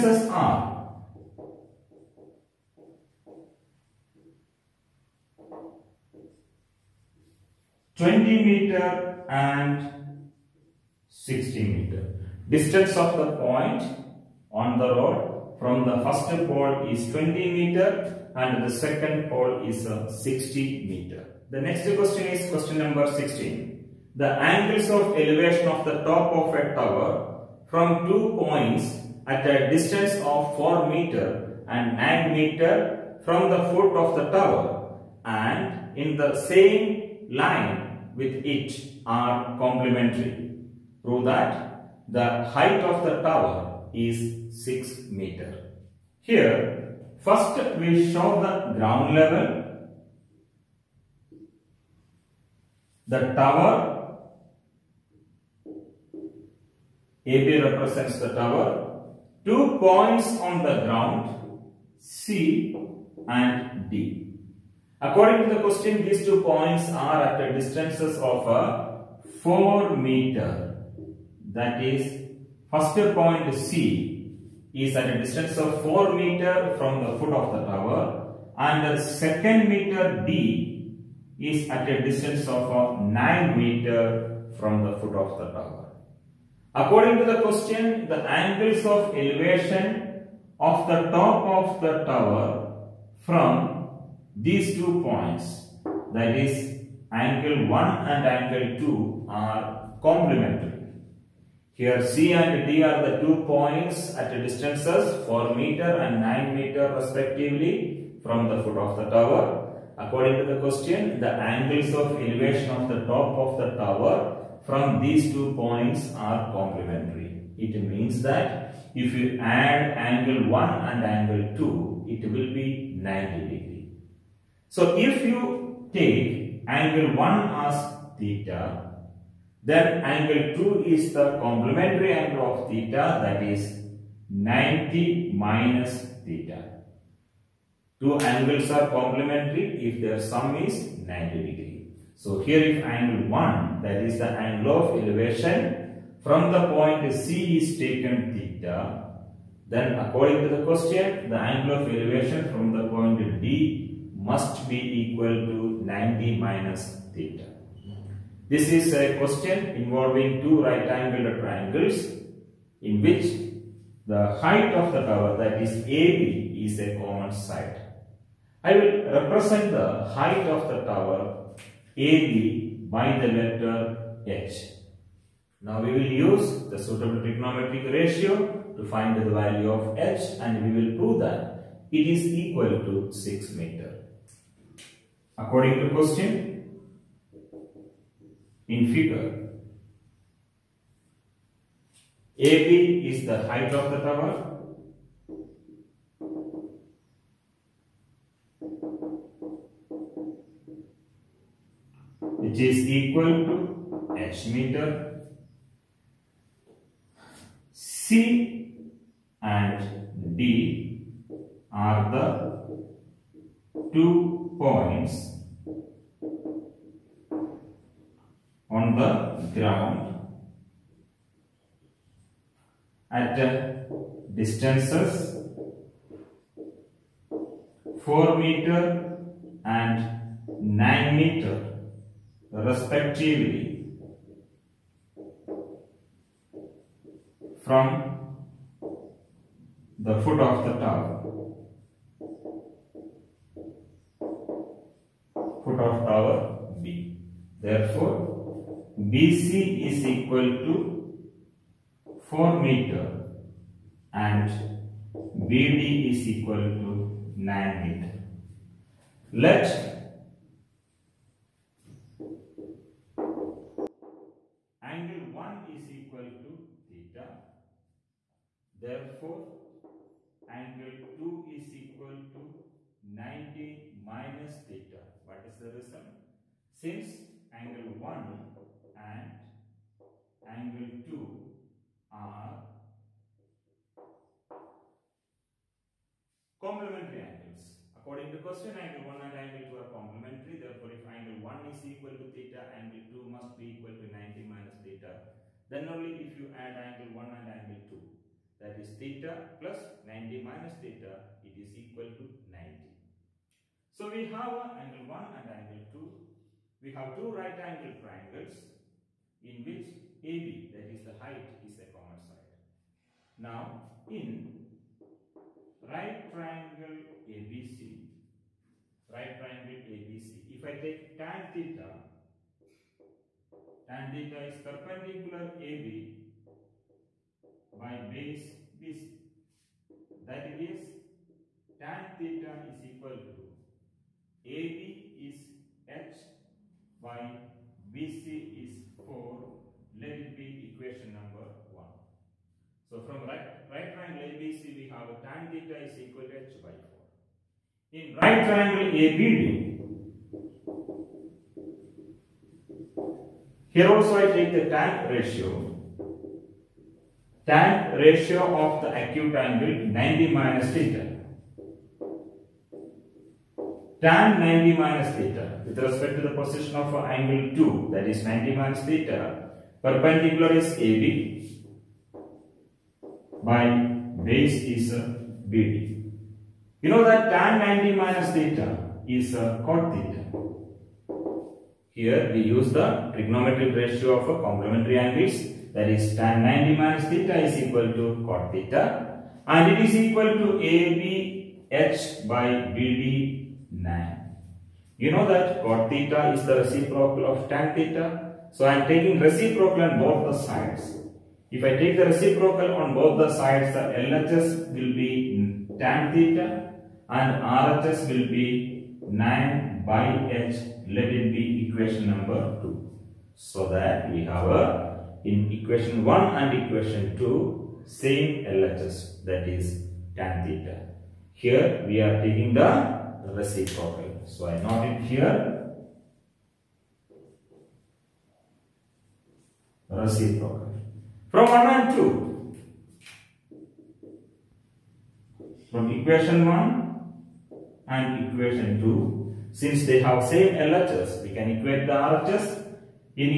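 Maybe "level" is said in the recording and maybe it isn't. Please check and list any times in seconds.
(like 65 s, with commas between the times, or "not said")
49 s.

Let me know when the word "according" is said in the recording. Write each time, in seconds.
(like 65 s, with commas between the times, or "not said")
64 s, 86 s, 109 s, 149 s, 185 s, 288 s.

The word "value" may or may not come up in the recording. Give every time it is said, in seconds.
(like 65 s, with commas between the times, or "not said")
179 s.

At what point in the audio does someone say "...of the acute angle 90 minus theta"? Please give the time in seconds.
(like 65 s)
358 s.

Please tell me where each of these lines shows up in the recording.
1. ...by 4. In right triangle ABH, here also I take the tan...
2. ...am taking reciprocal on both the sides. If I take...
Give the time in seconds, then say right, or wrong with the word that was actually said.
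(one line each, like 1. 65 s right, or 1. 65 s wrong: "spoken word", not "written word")
1. 346 s wrong: "ABD", not "ABH"
2. 398 s right.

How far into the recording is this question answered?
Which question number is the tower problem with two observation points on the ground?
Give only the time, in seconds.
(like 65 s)
22 s.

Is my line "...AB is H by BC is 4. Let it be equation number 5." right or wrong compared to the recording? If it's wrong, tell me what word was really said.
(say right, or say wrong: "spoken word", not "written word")
wrong: "1", not "5".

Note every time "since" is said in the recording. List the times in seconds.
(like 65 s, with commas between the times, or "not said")
276 s, 439 s.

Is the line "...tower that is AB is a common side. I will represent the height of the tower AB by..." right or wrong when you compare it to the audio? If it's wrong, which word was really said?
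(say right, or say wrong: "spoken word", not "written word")
right.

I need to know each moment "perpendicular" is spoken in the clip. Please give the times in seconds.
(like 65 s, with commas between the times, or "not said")
324 s, 369 s.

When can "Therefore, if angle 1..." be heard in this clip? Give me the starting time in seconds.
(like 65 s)
290 s.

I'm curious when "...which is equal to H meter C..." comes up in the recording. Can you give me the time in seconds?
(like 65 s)
202 s.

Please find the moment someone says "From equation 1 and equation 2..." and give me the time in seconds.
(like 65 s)
435 s.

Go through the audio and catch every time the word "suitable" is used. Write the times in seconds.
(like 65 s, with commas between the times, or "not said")
176 s.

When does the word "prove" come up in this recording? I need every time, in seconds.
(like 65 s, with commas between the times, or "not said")
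41 s, 180 s.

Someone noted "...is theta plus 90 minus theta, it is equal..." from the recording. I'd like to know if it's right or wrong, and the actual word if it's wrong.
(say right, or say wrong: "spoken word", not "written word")
right.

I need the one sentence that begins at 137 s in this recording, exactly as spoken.
Two angles are complementary if their sum is 90 degree.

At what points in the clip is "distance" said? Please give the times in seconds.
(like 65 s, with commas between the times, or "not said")
12 s, 29 s, 67 s, 75 s, 82 s, 104 s, 224 s.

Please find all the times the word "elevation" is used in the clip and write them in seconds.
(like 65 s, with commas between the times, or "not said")
25 s, 89 s, 112 s, 145 s, 151 s.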